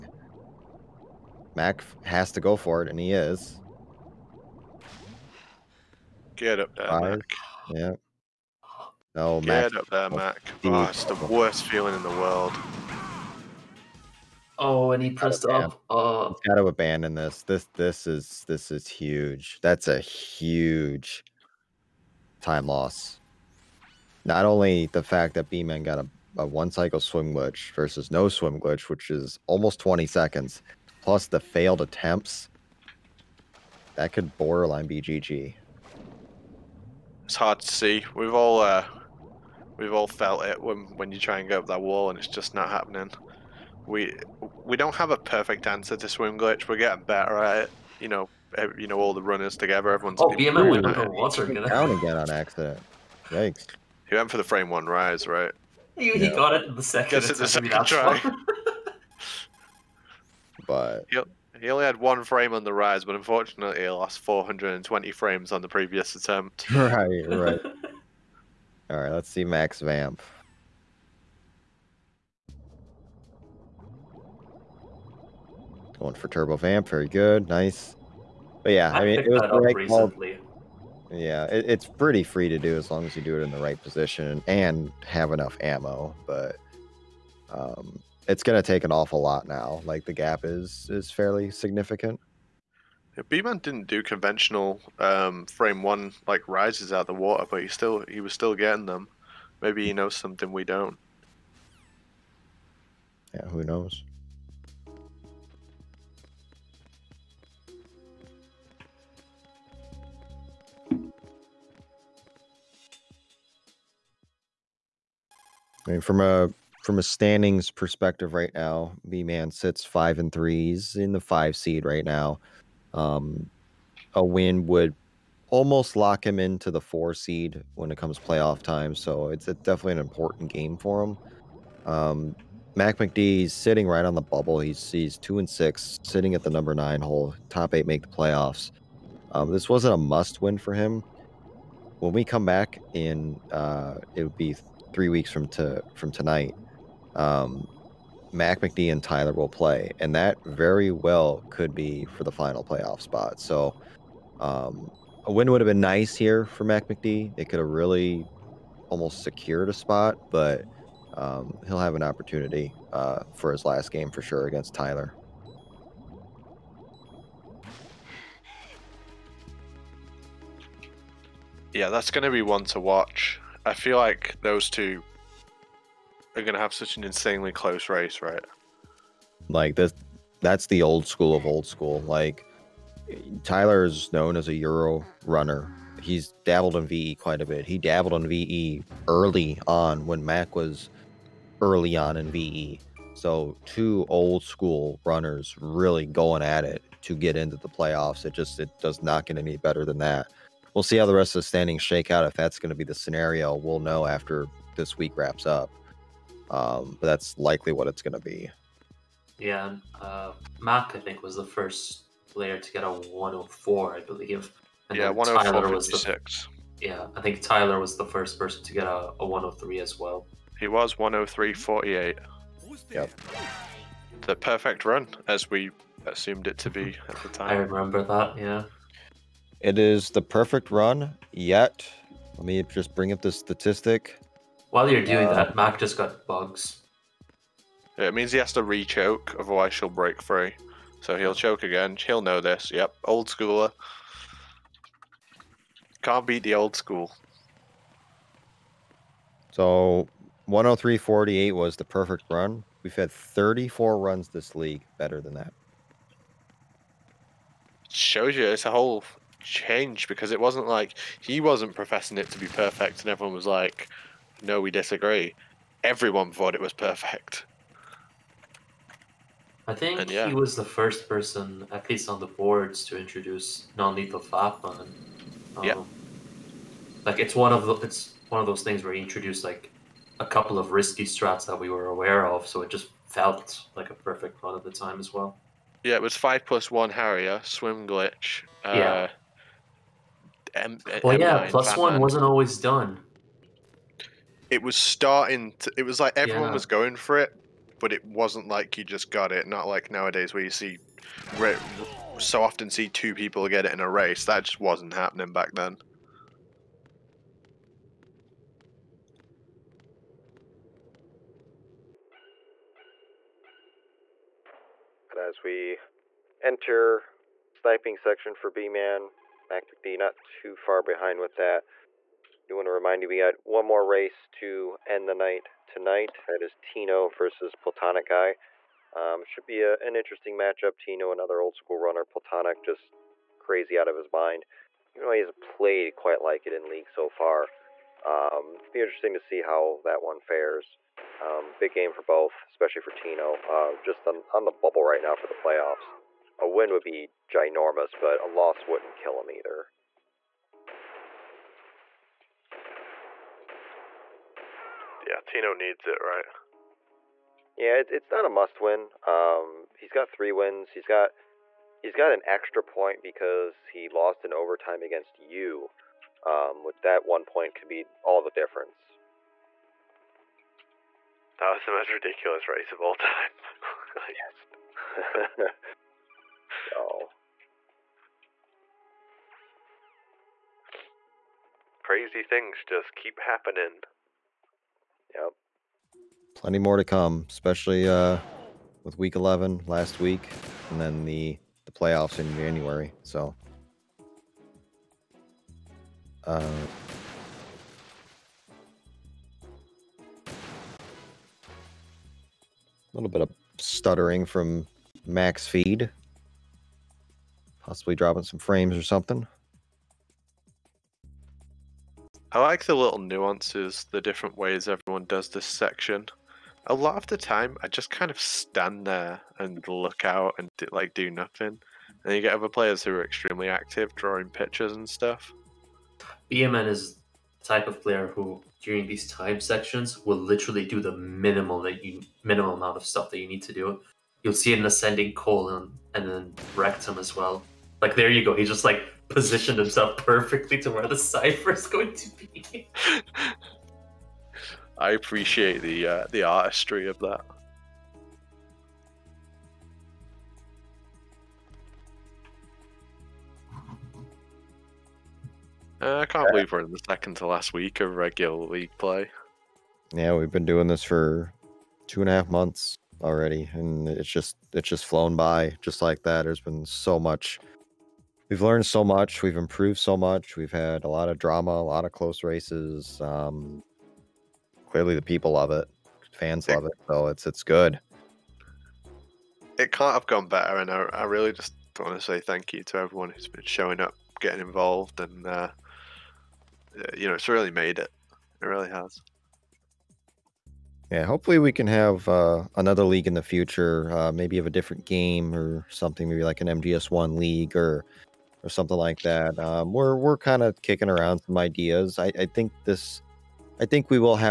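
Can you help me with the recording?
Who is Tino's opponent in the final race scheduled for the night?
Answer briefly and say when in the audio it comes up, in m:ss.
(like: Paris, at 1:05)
Platonic Guy, at 5:27.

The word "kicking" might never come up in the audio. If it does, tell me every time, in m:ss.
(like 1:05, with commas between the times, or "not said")
8:20.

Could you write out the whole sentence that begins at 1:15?
Going for Turbo Vamp, very good, nice.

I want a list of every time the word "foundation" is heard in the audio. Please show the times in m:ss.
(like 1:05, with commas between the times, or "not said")
not said.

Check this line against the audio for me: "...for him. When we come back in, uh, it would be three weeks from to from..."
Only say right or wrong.
right.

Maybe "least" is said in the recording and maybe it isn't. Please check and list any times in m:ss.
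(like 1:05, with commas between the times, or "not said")
4:31.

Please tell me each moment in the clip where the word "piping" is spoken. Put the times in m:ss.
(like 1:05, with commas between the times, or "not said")
not said.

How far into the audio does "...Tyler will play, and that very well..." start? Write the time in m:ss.
2:29.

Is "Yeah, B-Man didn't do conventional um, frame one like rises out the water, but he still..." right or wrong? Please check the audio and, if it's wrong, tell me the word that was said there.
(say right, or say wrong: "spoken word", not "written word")
right.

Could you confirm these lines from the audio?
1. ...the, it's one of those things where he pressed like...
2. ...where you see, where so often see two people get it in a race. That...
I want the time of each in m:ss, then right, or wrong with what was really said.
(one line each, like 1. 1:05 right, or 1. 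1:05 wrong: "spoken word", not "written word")
1. 4:37 wrong: "introduced", not "pressed"
2. 5:00 right.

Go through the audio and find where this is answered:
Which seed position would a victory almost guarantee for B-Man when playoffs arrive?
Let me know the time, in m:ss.
2:06.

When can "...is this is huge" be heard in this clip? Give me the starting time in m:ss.
0:18.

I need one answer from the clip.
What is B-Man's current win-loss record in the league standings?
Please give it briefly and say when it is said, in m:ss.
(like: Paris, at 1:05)
5 and 3, at 1:59.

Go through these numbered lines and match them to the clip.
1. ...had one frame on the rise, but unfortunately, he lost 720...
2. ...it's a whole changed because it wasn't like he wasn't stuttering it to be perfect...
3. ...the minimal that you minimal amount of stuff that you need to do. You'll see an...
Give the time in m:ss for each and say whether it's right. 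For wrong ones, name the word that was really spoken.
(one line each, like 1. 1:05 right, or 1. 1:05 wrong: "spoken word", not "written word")
1. 1:01 wrong: "420", not "720"
2. 4:18 wrong: "professing", not "stuttering"
3. 7:10 right.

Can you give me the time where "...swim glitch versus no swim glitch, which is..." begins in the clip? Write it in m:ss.
0:26.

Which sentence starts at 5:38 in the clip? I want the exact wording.
Um, be interesting to see how that one fares.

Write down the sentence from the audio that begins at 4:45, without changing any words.
Yeah, it was five plus one Harrier, swim glitch, uh, yeah.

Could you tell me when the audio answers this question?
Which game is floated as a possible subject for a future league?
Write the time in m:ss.
8:16.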